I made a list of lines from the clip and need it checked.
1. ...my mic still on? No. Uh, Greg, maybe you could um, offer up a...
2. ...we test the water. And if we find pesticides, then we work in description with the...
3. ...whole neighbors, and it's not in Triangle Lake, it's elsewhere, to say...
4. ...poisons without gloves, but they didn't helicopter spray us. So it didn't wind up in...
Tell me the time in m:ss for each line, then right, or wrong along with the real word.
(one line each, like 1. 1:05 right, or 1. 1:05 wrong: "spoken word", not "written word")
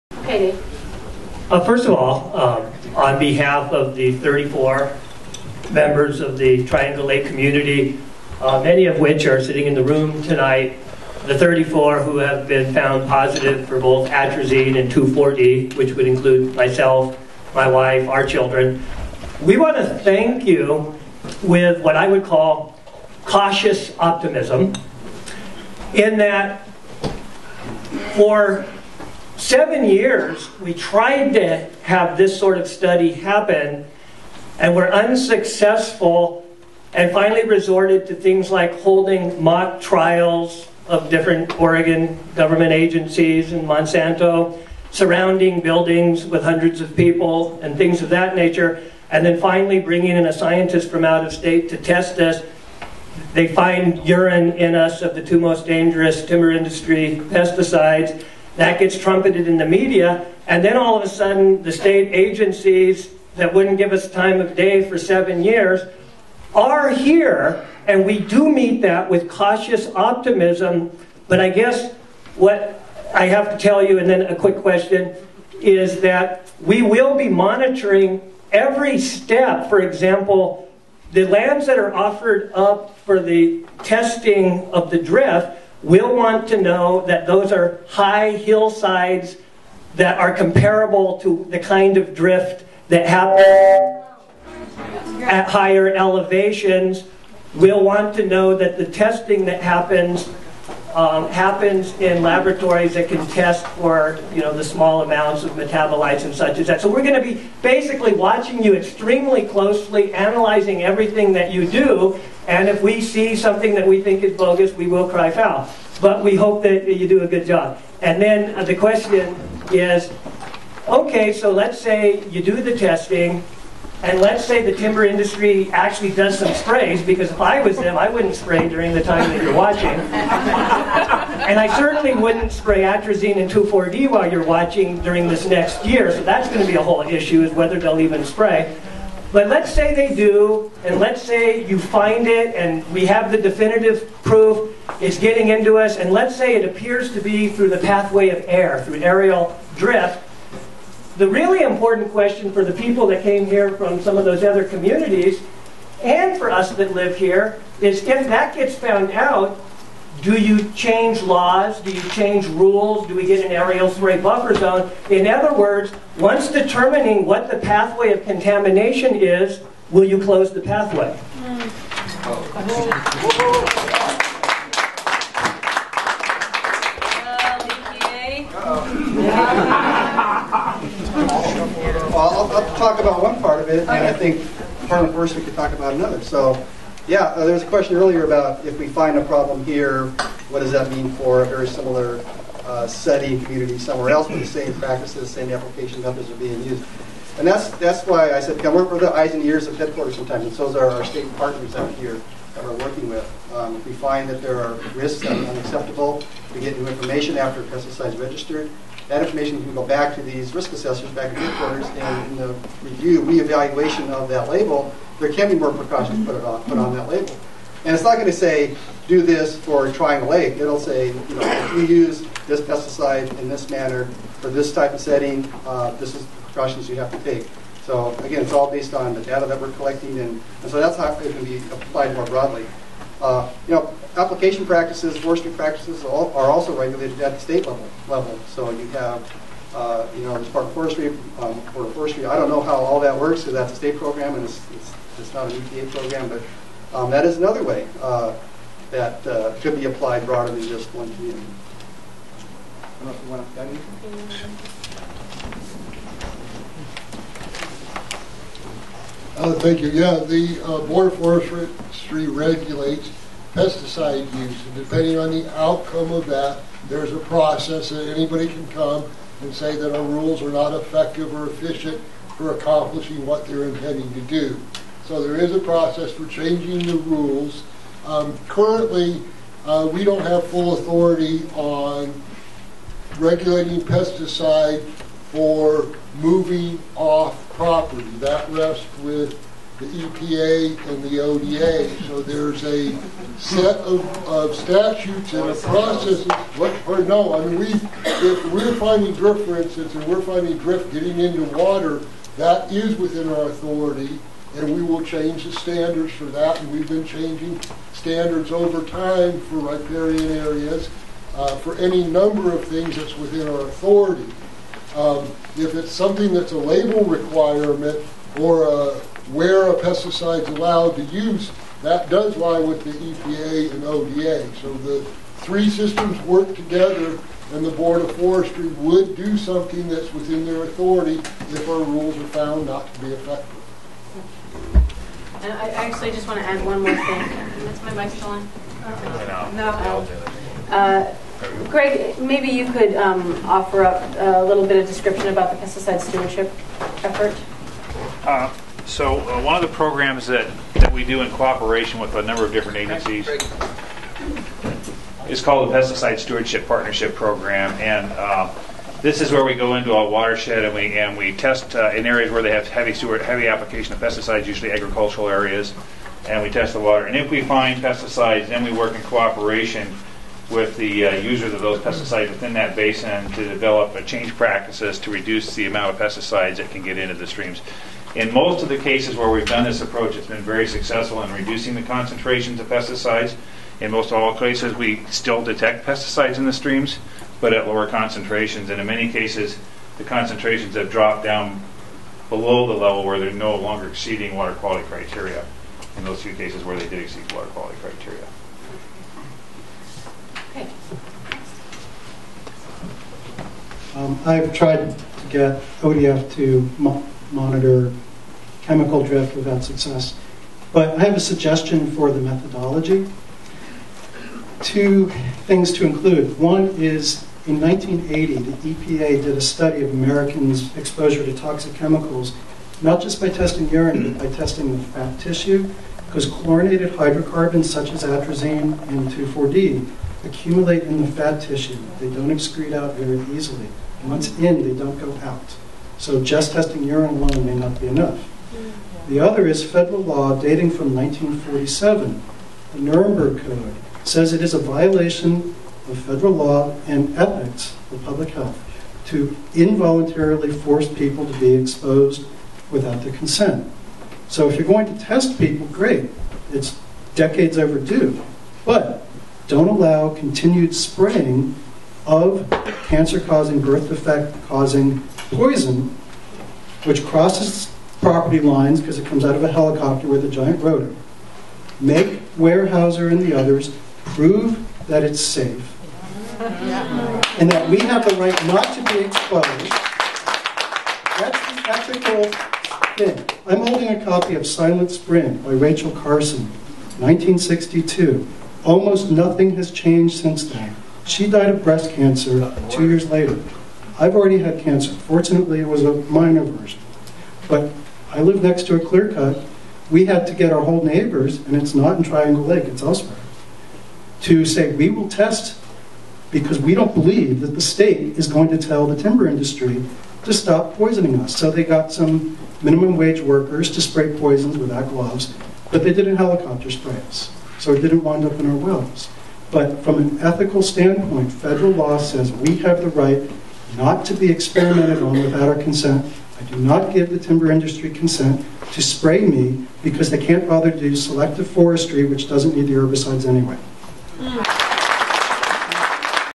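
1. 5:37 right
2. 6:06 wrong: "cooperation", not "description"
3. 8:20 right
4. 8:34 right.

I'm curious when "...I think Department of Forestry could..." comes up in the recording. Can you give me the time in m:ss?
3:03.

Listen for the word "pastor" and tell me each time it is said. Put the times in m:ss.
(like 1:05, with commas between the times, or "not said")
not said.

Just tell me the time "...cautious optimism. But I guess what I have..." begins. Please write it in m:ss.
1:09.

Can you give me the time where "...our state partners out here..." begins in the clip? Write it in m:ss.
3:20.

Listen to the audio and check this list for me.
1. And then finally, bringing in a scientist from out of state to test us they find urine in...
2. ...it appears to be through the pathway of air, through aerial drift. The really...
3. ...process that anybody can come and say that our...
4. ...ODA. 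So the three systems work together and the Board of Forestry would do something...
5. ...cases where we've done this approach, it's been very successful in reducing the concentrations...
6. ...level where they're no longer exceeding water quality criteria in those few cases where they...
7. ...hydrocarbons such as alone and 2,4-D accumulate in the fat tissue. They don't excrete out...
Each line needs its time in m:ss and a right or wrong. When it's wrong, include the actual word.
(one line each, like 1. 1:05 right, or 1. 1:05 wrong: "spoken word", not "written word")
1. 0:49 right
2. 2:26 right
3. 4:27 right
4. 5:23 right
5. 6:18 right
6. 6:32 right
7. 7:06 wrong: "atrazine", not "alone".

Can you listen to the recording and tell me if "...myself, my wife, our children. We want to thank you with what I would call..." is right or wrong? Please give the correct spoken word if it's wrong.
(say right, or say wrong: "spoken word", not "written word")
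right.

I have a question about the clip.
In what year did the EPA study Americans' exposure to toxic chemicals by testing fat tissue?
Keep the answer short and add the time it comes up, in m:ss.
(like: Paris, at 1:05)
1980, at 6:57.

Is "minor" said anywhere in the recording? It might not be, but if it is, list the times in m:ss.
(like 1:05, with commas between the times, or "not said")
8:16.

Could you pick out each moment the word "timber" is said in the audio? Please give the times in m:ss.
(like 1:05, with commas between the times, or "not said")
0:56, 2:04, 8:28, 8:47.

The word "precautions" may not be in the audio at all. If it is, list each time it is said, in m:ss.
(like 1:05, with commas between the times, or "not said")
3:35, 3:46.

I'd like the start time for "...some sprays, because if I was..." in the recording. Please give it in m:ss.
2:06.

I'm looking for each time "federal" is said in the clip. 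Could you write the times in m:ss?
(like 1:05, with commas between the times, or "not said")
7:19, 7:25, 8:41.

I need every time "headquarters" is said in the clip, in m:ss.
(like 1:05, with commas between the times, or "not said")
3:19, 3:31.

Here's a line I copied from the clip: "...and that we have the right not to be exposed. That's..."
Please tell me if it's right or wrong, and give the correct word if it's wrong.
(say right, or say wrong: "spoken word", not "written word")
right.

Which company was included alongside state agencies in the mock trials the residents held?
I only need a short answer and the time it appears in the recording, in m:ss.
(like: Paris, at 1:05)
Monsanto, at 0:43.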